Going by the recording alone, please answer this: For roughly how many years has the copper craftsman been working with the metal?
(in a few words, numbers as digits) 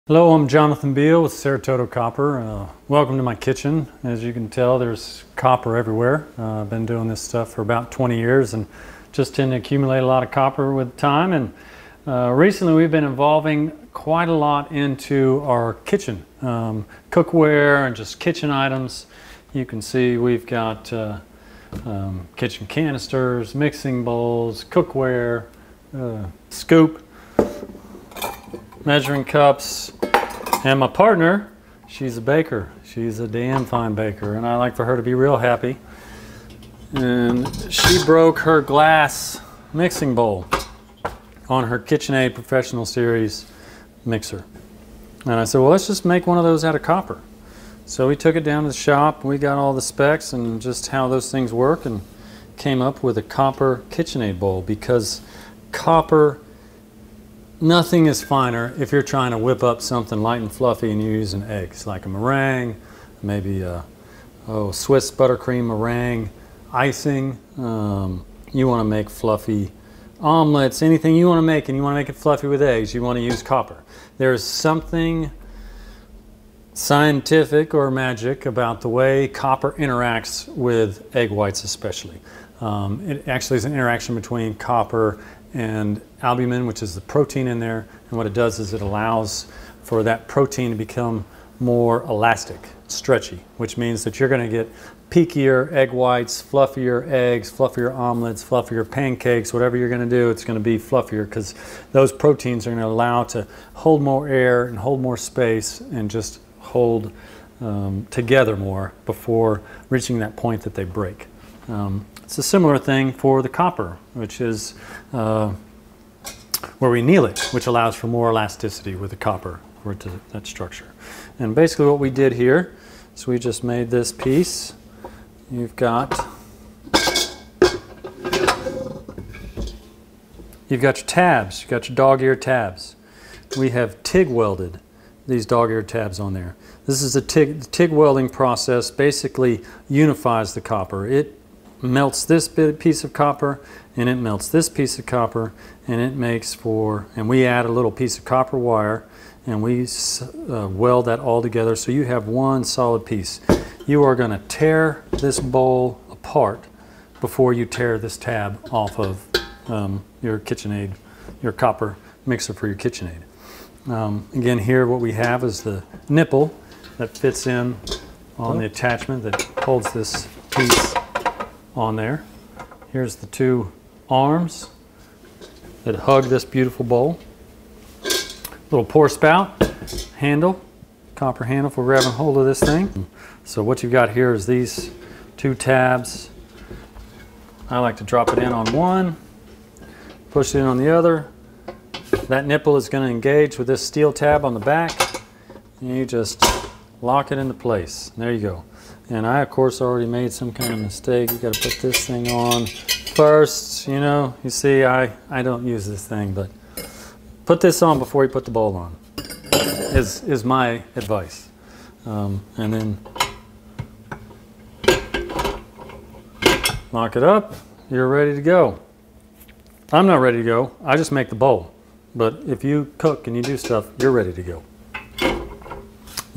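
20 years.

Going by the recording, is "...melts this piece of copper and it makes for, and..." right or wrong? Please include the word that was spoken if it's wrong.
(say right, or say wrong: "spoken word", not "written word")
right.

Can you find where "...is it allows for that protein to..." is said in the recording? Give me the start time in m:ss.
1:28.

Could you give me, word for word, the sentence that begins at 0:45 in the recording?
And I said, well, let's just make one of those out of copper.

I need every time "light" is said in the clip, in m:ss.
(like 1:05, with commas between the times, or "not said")
1:00.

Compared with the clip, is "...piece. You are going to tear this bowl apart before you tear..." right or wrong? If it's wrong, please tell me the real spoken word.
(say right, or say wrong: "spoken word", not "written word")
right.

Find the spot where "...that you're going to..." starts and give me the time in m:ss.
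1:34.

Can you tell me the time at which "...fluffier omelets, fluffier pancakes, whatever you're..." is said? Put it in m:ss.
1:37.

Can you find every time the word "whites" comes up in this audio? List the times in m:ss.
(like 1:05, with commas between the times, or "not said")
1:21, 1:35.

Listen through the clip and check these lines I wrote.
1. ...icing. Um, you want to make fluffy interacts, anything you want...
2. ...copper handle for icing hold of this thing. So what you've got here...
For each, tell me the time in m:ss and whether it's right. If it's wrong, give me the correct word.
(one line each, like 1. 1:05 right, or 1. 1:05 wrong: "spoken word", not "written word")
1. 1:06 wrong: "omelets", not "interacts"
2. 3:01 wrong: "grabbing", not "icing".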